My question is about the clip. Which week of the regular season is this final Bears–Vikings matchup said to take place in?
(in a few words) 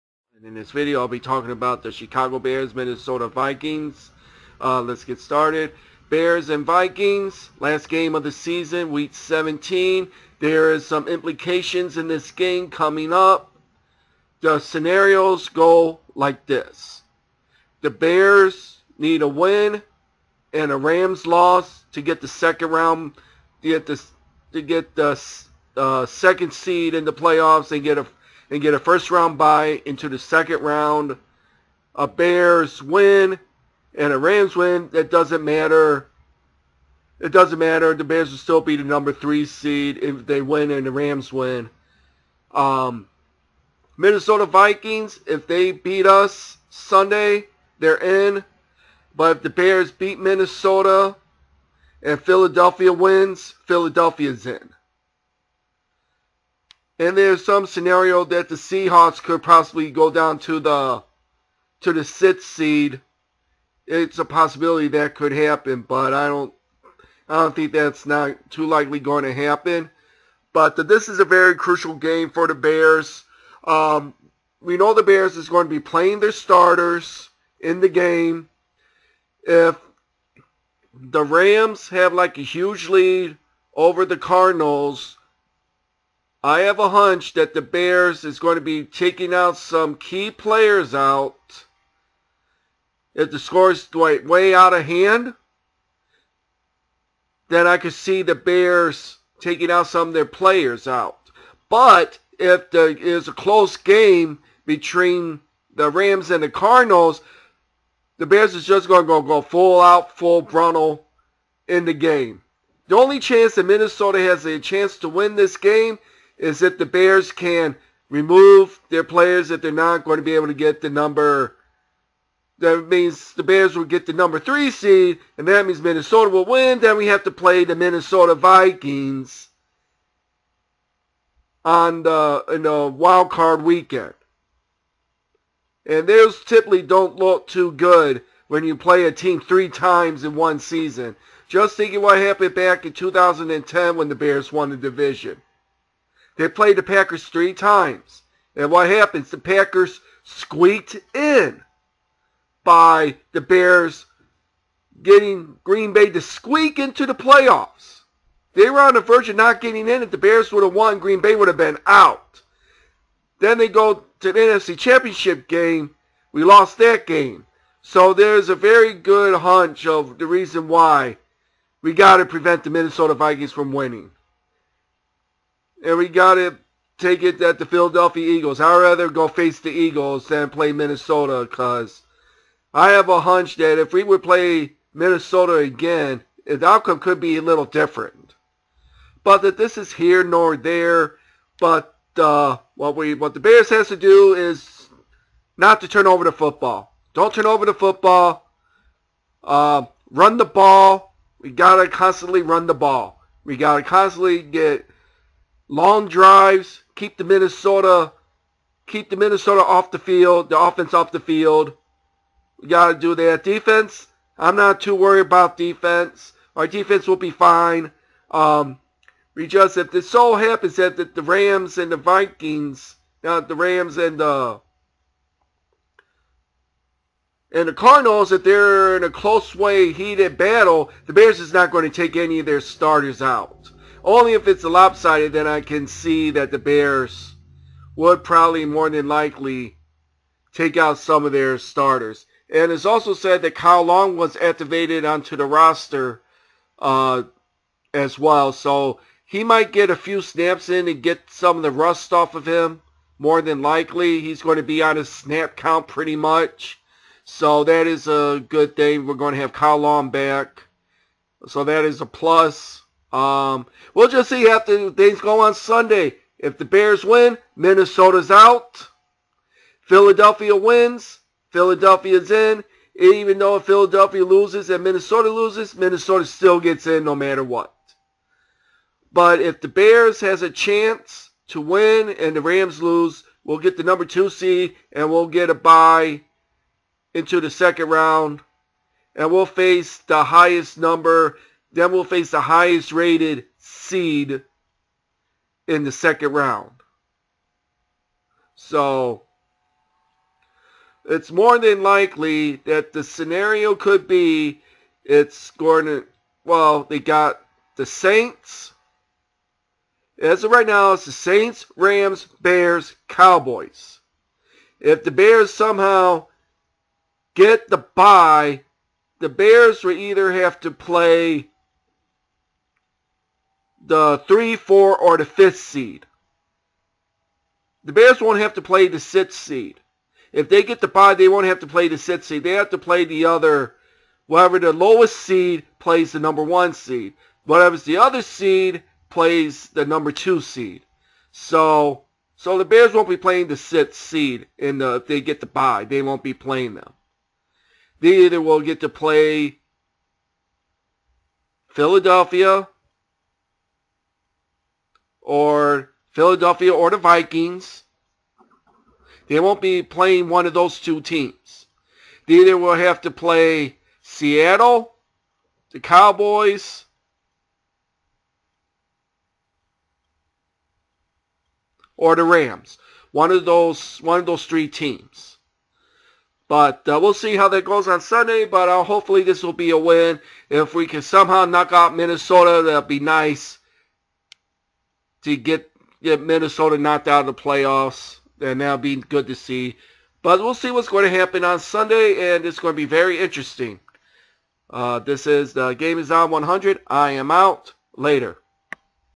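Week 17.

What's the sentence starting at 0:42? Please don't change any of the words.
Um, Minnesota Vikings, if they beat us Sunday, they're in.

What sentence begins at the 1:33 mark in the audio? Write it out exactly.
If the score is like way out of hand, then I could see the Bears taking out some of their players out.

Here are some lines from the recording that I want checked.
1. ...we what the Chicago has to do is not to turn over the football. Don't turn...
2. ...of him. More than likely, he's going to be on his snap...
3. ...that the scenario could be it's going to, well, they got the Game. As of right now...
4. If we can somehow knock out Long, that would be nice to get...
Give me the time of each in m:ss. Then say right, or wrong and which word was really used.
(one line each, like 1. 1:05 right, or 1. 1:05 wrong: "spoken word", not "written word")
1. 3:12 wrong: "Bears", not "Chicago"
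2. 4:12 right
3. 5:02 wrong: "Saints", not "Game"
4. 6:20 wrong: "Minnesota", not "Long".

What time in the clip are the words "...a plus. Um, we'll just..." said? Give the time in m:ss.
4:22.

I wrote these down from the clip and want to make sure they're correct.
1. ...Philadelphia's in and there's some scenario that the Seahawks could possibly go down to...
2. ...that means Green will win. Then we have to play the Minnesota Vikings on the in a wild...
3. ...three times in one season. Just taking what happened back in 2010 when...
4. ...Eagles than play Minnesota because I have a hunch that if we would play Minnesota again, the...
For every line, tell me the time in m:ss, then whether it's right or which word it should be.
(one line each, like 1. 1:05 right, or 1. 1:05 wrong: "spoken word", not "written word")
1. 0:53 right
2. 2:05 wrong: "Minnesota", not "Green"
3. 2:19 wrong: "thinking", not "taking"
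4. 2:59 right.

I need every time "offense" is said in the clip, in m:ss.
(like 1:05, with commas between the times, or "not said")
3:30.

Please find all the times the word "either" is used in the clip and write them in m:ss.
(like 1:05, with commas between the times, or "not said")
5:19, 5:48, 6:02.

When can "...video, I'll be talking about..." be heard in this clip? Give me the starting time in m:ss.
0:00.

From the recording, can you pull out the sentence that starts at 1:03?
It's a possibility that could happen, but I don't I don't think that's not too likely going to happen.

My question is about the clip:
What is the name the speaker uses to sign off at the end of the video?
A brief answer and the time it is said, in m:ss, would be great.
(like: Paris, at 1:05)
Game is On 100, at 6:35.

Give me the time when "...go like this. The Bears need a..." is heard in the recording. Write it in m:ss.
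0:15.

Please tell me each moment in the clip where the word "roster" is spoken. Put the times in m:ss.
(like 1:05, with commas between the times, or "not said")
4:05.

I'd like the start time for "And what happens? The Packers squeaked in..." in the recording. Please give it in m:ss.
2:28.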